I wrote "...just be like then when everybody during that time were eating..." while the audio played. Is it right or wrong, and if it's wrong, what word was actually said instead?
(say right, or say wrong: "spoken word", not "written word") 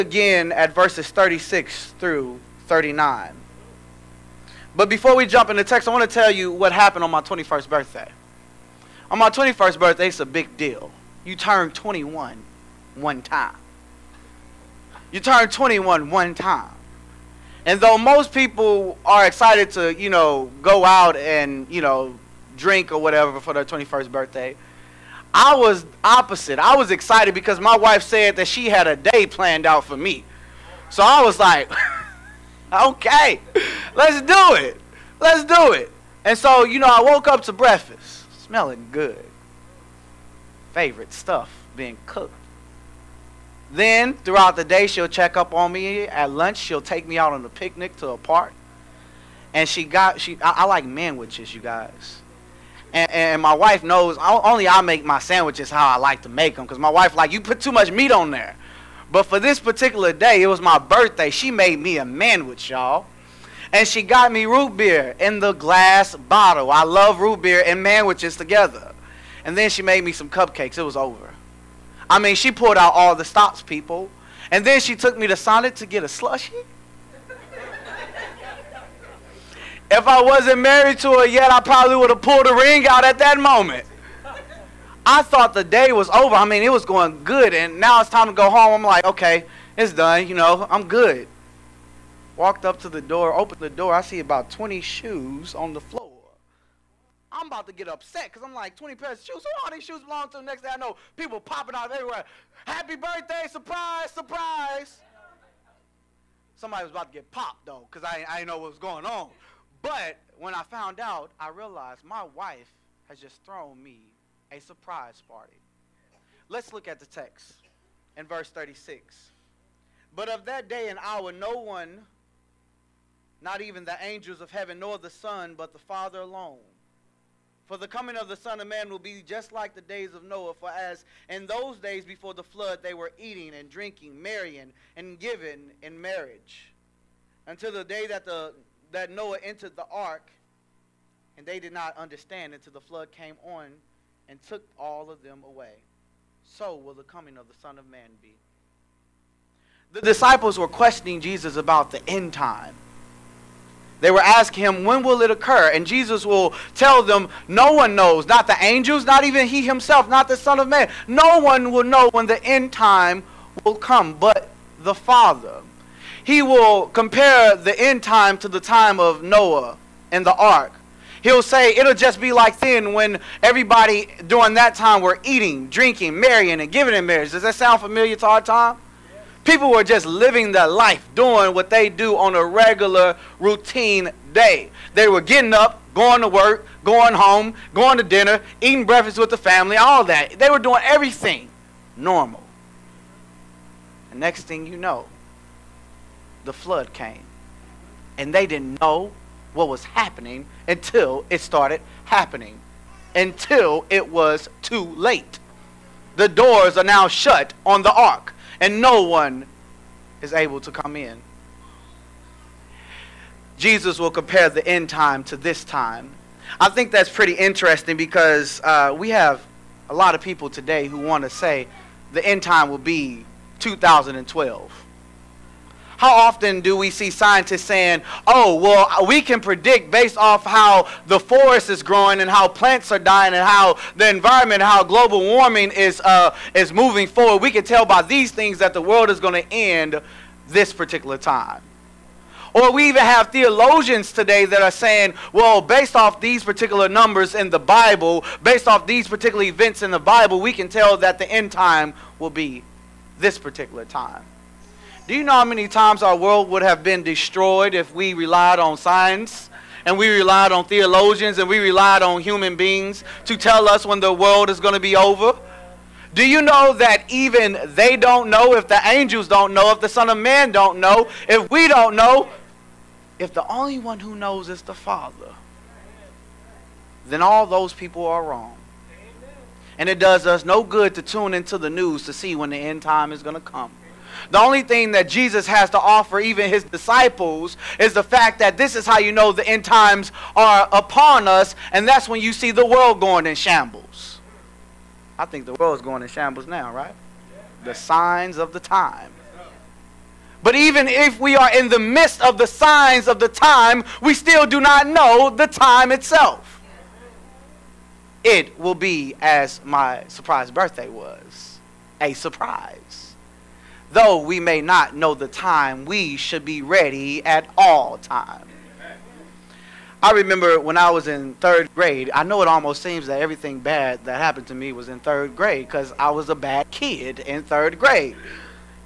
right.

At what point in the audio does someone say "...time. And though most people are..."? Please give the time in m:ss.
0:16.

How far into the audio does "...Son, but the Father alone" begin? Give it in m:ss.
2:05.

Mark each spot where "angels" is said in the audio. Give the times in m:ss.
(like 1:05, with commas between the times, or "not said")
2:04, 2:38, 4:28.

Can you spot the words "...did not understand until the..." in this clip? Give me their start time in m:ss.
2:21.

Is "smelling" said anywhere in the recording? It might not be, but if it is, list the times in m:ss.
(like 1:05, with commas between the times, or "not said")
0:38.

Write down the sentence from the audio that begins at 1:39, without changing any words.
Who all these shoes belong to?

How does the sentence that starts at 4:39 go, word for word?
And it does us no good to tune into the news to see when the end time is going to come.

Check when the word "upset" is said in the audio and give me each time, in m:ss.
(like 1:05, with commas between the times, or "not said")
1:37.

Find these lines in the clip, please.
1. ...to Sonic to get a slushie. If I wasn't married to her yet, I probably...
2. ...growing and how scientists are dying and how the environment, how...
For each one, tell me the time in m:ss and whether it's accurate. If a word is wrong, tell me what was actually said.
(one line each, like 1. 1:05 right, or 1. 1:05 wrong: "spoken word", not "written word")
1. 1:15 right
2. 3:51 wrong: "plants", not "scientists".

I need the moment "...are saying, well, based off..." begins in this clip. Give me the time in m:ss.
4:04.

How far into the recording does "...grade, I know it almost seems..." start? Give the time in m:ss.
5:21.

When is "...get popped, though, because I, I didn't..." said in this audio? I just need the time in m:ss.
1:47.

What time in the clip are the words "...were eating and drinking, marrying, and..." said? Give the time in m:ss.
2:12.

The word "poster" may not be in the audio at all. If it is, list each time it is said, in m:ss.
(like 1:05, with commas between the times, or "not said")
not said.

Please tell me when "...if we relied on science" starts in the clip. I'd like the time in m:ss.
4:17.